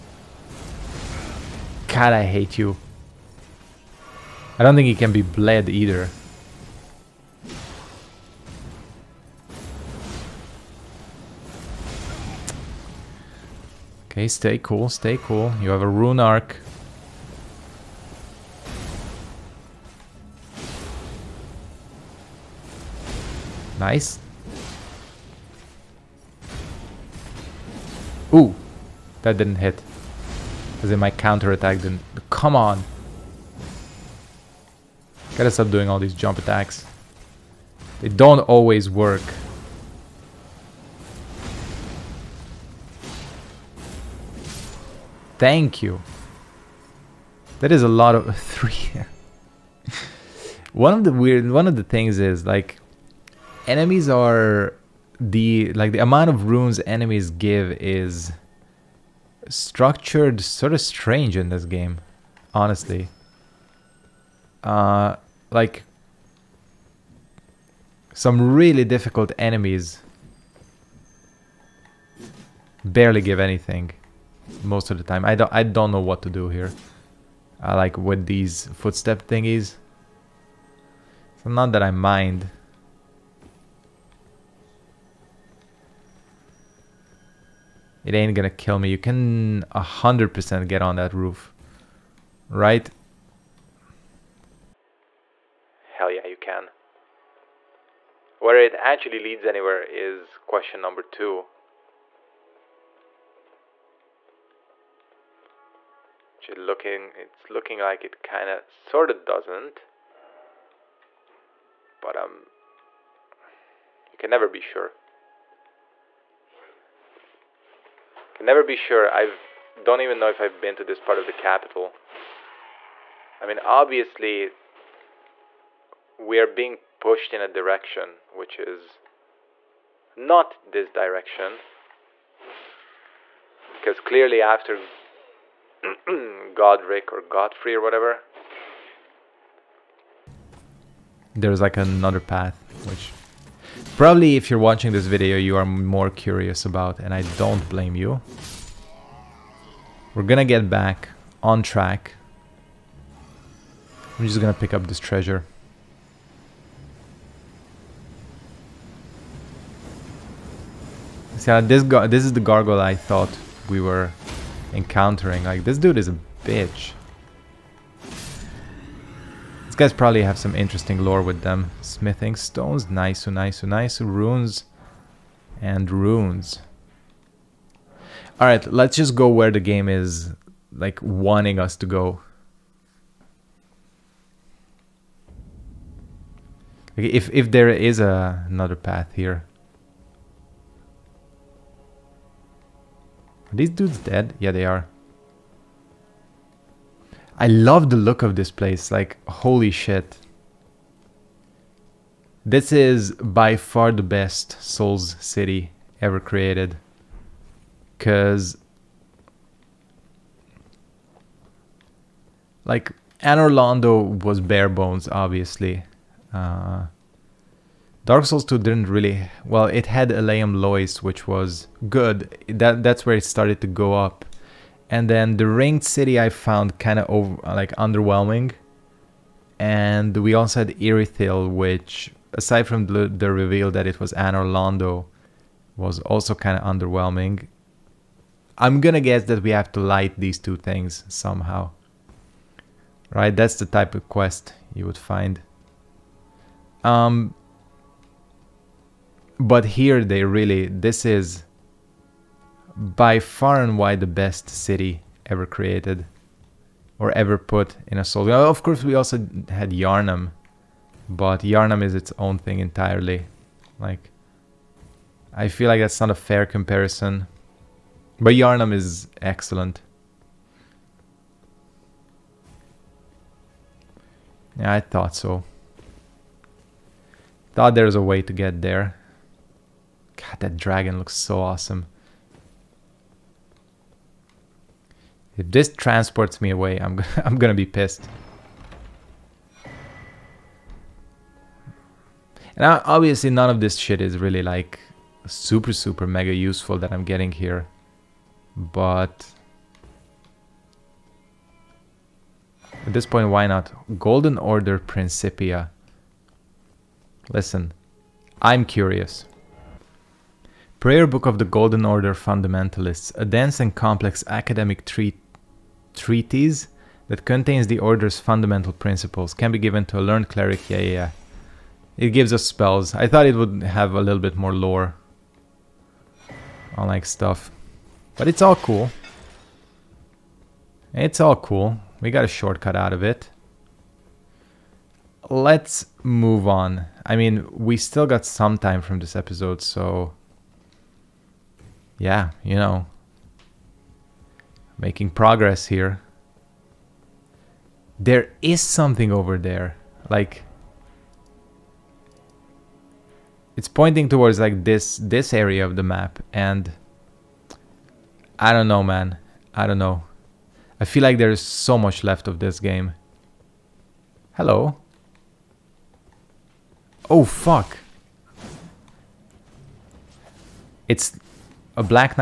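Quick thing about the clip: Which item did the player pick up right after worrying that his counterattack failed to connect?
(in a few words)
Rune arc.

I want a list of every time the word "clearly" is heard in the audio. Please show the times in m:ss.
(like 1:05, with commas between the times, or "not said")
2:14.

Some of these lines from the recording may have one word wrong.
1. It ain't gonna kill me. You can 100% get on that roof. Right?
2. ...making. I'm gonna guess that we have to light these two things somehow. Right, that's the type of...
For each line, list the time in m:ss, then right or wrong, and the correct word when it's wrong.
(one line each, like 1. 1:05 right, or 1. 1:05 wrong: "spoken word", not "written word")
1. 1:28 right
2. 3:56 wrong: "underwhelming", not "making".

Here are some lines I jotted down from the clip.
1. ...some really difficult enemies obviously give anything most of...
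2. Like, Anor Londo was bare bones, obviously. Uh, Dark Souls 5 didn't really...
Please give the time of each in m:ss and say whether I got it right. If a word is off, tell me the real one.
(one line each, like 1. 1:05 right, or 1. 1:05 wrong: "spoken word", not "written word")
1. 1:08 wrong: "barely", not "obviously"
2. 3:32 wrong: "2", not "5".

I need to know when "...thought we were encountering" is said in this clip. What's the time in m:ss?
2:42.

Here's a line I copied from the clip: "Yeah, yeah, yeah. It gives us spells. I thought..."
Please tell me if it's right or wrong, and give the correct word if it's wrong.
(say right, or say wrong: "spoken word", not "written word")
right.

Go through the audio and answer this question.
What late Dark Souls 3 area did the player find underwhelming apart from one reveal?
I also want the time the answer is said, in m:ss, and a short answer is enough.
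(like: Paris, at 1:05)
Irithyll, at 3:50.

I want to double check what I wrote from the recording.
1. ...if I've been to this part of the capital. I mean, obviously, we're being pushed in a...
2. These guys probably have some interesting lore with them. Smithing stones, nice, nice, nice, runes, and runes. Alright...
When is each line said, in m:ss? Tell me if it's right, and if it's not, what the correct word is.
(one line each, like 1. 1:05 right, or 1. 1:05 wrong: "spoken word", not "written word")
1. 2:00 right
2. 2:48 right.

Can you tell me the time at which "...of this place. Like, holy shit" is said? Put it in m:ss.
3:18.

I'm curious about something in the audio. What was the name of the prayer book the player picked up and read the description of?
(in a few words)
Golden Order Principia.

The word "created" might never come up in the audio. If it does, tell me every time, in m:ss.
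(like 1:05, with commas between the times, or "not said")
3:26, 4:15.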